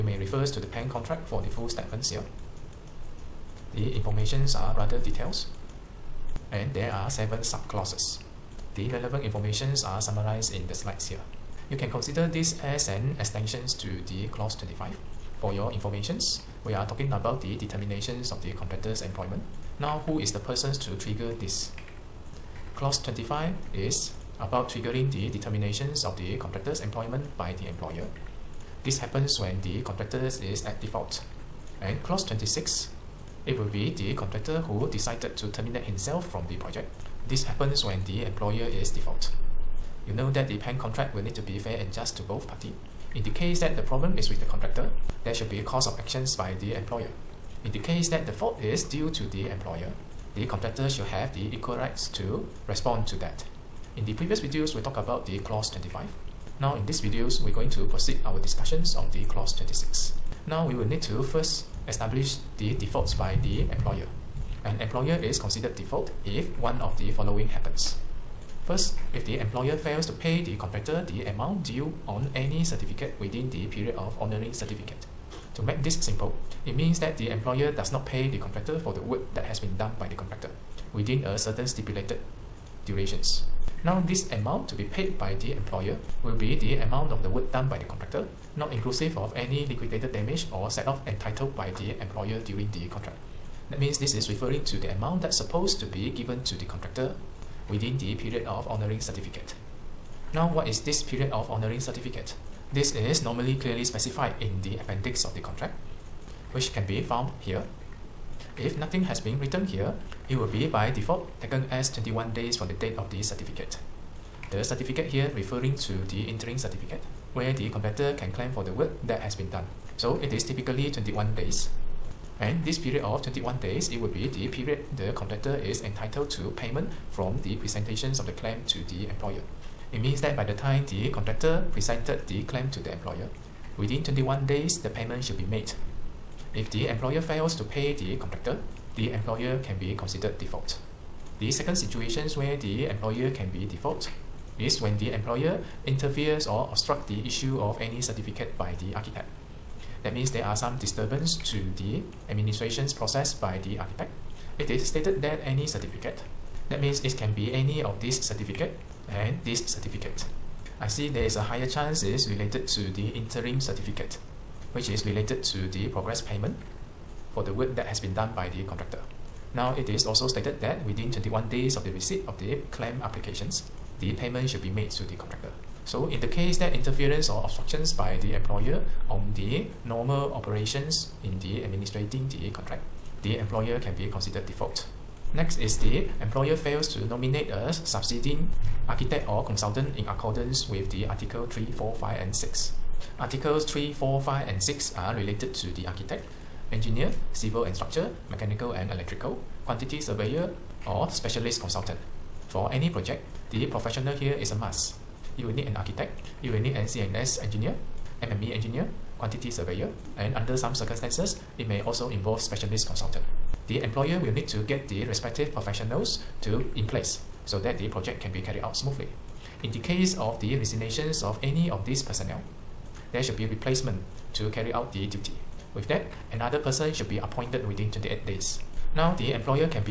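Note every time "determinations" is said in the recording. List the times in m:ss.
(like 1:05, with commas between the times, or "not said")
0:17, 0:25.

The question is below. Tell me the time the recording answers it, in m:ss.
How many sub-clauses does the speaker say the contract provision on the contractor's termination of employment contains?
0:07.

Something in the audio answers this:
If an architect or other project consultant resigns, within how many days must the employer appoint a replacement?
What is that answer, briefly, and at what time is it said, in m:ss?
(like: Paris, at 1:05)
28 days, at 3:47.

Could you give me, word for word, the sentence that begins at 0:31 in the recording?
And clause 26, it will be the contractor who decided to terminate himself from the project.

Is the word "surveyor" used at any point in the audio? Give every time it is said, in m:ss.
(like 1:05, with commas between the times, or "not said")
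3:19, 3:29.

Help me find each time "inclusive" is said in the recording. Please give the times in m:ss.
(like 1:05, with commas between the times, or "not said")
1:28.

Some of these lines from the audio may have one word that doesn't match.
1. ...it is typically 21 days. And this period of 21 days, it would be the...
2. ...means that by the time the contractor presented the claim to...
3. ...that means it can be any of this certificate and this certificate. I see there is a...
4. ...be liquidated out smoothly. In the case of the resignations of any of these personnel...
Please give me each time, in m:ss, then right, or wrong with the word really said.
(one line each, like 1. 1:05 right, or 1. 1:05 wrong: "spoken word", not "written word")
1. 2:00 right
2. 2:09 right
3. 2:36 right
4. 3:38 wrong: "carried", not "liquidated".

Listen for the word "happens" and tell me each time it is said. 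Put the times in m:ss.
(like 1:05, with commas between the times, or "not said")
0:29, 0:37, 1:07.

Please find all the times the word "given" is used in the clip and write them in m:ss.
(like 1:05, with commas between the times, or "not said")
1:36.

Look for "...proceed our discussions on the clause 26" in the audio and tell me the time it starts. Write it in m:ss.
0:57.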